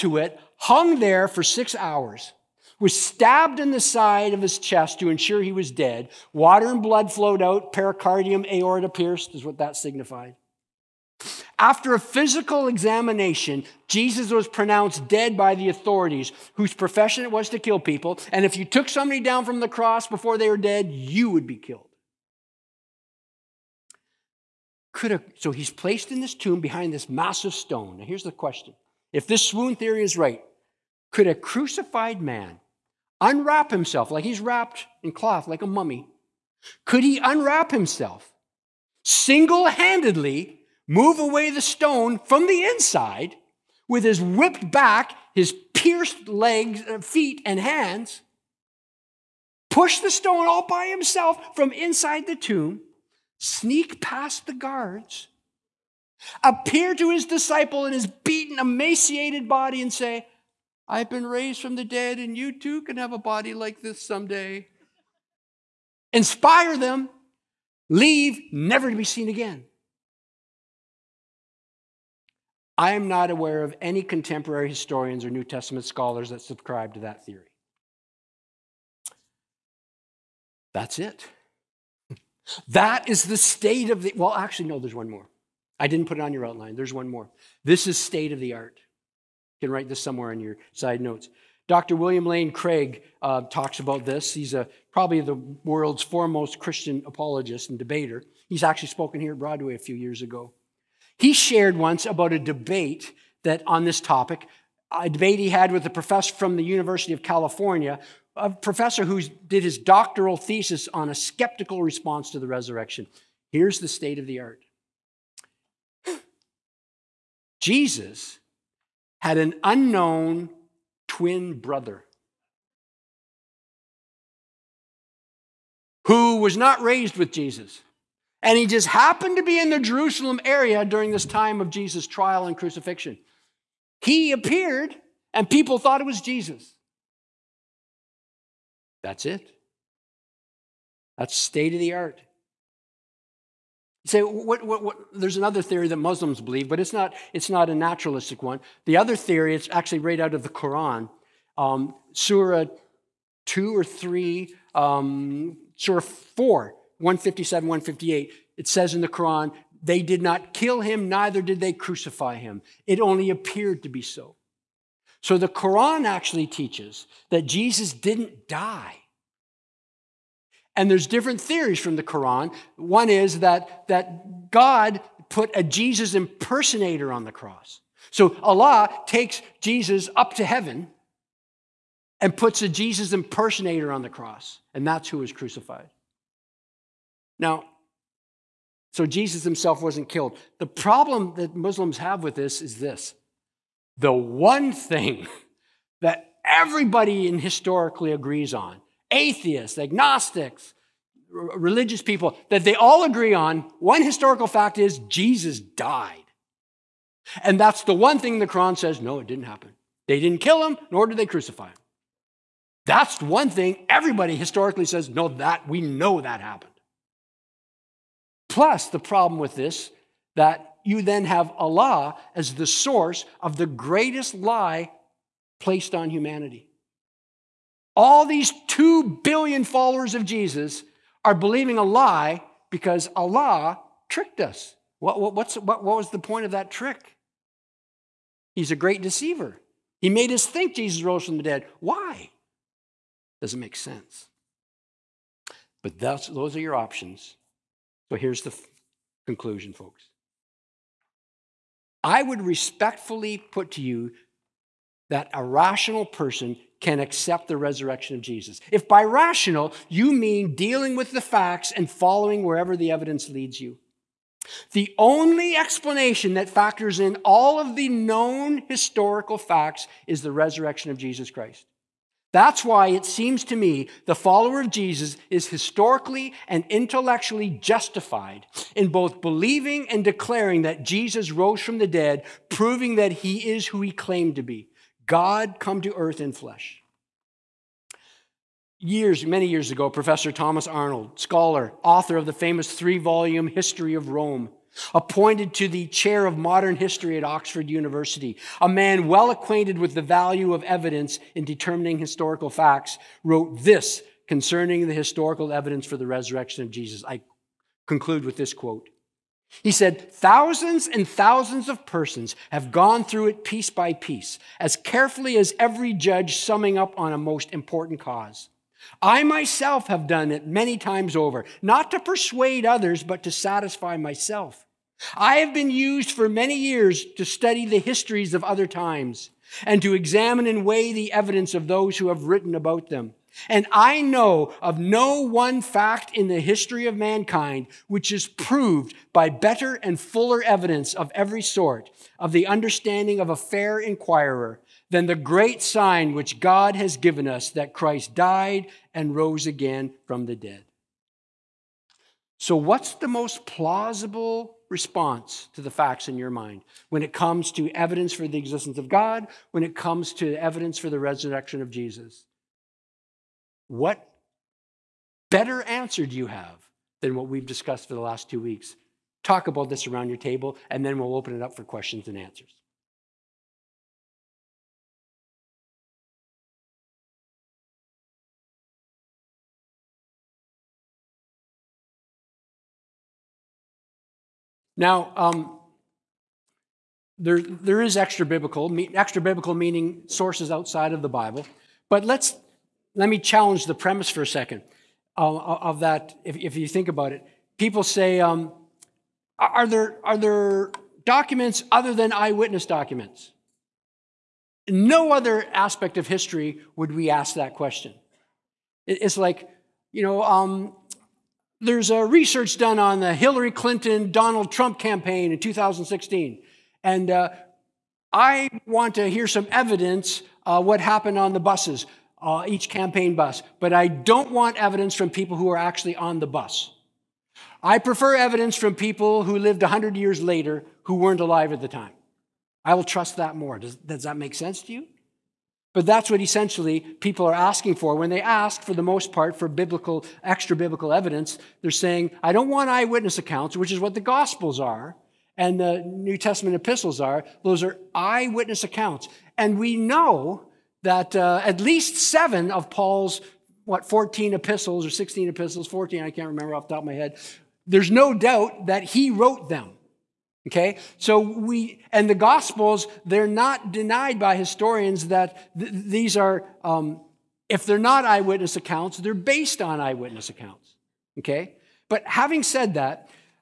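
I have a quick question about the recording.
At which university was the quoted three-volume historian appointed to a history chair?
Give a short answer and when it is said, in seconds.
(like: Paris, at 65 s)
Oxford University, at 297 s.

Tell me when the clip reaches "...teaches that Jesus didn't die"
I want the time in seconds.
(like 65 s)
166 s.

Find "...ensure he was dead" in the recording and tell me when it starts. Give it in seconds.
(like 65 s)
5 s.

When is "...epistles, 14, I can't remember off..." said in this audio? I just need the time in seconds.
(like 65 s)
455 s.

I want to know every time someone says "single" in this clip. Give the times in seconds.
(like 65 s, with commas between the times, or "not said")
39 s.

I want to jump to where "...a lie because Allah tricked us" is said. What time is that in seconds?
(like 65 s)
231 s.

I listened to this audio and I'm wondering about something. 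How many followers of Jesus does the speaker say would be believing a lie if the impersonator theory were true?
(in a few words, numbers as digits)
2 billion.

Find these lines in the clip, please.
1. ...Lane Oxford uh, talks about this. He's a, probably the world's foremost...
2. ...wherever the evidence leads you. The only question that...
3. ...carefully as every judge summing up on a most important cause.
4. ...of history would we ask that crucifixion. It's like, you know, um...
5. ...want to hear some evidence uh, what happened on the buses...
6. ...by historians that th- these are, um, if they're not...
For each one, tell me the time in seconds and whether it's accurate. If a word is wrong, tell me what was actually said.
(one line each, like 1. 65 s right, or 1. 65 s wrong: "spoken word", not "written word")
1. 92 s wrong: "Craig", not "Oxford"
2. 262 s wrong: "explanation", not "question"
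3. 314 s right
4. 405 s wrong: "question", not "crucifixion"
5. 418 s right
6. 464 s right.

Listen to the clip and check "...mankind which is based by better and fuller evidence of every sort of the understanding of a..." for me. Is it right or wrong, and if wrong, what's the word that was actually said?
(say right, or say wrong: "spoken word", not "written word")
wrong: "proved", not "based".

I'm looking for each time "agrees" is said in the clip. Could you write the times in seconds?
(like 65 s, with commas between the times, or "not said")
198 s, 203 s.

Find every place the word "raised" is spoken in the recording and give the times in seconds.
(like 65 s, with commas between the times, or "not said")
61 s, 126 s.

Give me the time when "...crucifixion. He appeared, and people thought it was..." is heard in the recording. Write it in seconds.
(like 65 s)
132 s.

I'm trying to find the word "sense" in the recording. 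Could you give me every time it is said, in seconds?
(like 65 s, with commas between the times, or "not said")
243 s, 434 s.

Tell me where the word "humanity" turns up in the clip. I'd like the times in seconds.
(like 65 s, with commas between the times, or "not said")
226 s.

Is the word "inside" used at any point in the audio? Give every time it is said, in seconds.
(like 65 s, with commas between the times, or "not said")
42 s, 51 s.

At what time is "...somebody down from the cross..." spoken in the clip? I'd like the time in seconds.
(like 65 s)
18 s.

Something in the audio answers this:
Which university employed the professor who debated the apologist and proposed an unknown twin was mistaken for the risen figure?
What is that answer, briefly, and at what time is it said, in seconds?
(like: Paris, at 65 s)
University of California, at 106 s.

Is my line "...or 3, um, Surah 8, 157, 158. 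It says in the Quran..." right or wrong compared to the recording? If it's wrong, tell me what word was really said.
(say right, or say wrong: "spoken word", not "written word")
wrong: "4", not "8".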